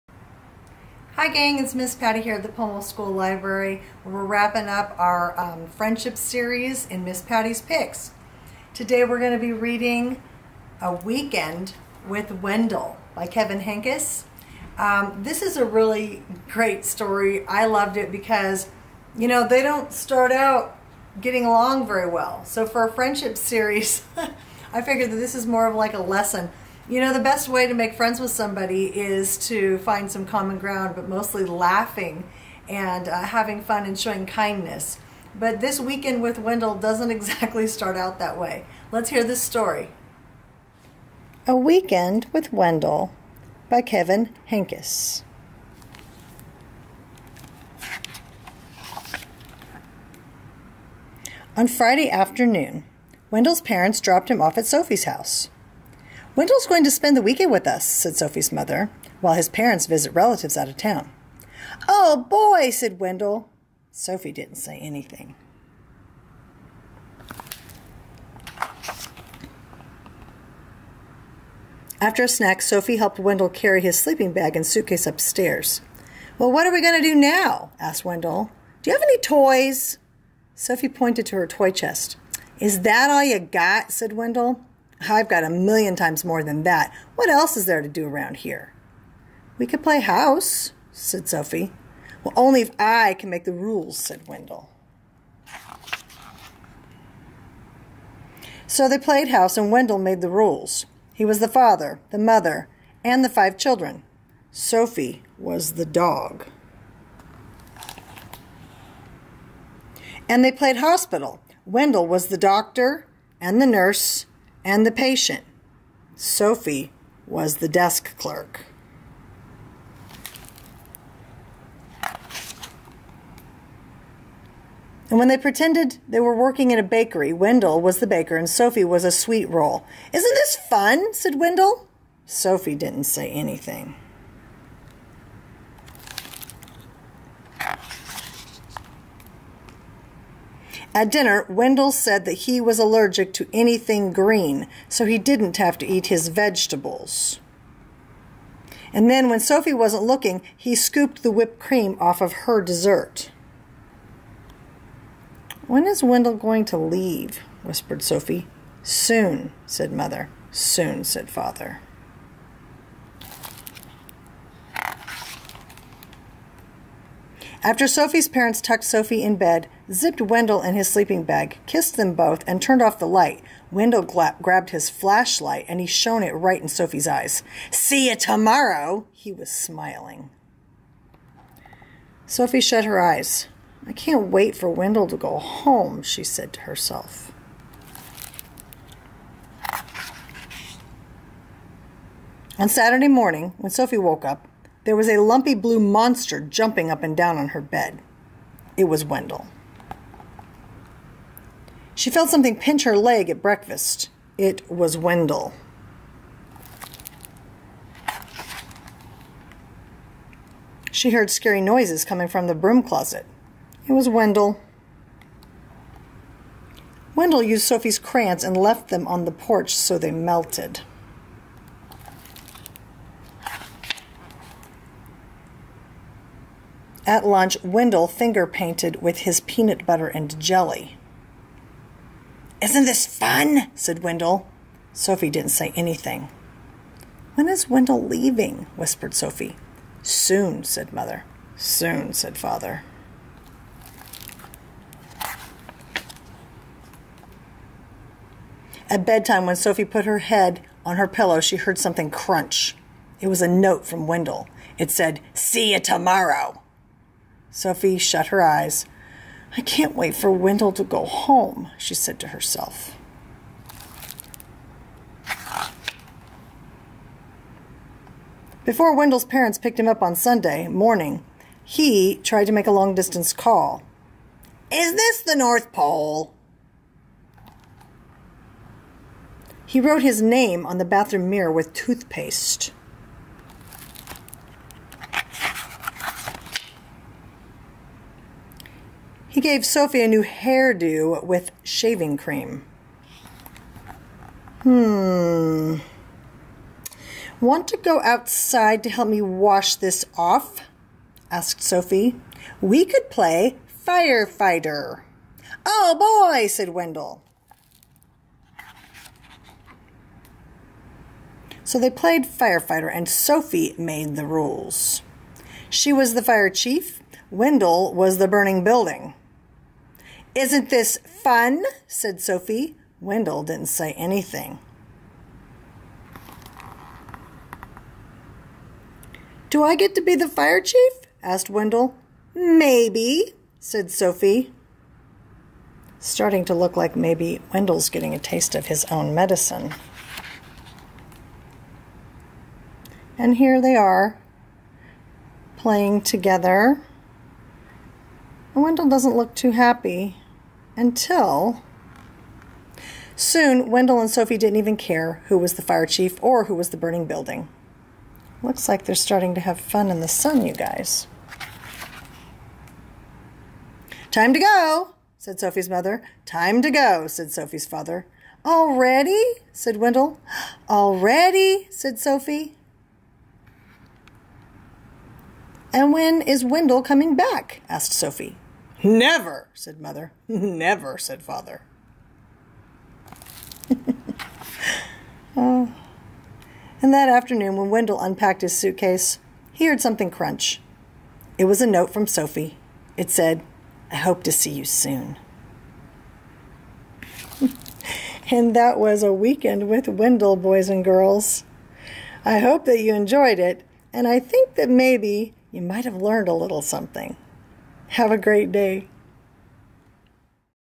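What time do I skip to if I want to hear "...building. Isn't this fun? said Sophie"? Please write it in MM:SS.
05:18.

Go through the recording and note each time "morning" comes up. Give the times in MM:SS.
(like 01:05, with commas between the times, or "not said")
03:13, 04:30.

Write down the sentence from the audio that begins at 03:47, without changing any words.
At lunch, Wendell finger painted with his peanut butter and jelly.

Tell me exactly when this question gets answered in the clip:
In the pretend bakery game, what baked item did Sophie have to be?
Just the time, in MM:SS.
02:09.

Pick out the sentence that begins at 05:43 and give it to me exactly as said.
And here they are playing together.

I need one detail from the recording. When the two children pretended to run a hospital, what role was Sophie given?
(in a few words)
desk clerk.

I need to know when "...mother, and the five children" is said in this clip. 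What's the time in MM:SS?
01:42.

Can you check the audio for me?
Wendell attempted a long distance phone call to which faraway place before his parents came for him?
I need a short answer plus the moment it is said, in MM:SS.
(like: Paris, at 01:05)
North Pole, at 04:35.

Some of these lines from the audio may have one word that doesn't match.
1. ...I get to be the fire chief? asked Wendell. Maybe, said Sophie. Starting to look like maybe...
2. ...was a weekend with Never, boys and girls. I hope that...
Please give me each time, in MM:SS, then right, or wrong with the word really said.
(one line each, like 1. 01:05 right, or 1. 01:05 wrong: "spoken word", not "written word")
1. 05:29 right
2. 06:38 wrong: "Wendell", not "Never".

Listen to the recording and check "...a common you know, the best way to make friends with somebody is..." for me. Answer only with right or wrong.
wrong.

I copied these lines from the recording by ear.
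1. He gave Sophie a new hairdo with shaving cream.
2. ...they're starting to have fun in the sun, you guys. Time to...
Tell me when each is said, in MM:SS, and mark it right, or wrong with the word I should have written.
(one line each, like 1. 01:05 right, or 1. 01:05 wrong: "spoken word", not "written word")
1. 04:49 right
2. 05:58 right.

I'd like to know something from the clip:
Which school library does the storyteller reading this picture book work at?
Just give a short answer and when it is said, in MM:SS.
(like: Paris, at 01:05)
Pomo School Library, at 00:02.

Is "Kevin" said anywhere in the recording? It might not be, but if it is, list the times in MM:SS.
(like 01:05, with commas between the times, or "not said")
00:13, 00:43.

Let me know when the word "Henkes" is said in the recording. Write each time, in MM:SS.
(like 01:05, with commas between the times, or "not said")
00:13, 00:44.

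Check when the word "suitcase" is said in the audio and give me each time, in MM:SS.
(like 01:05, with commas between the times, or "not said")
01:14, 06:28.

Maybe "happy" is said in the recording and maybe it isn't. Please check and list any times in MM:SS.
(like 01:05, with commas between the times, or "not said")
05:49.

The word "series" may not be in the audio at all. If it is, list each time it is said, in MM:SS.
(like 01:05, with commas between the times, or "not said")
00:06, 00:23.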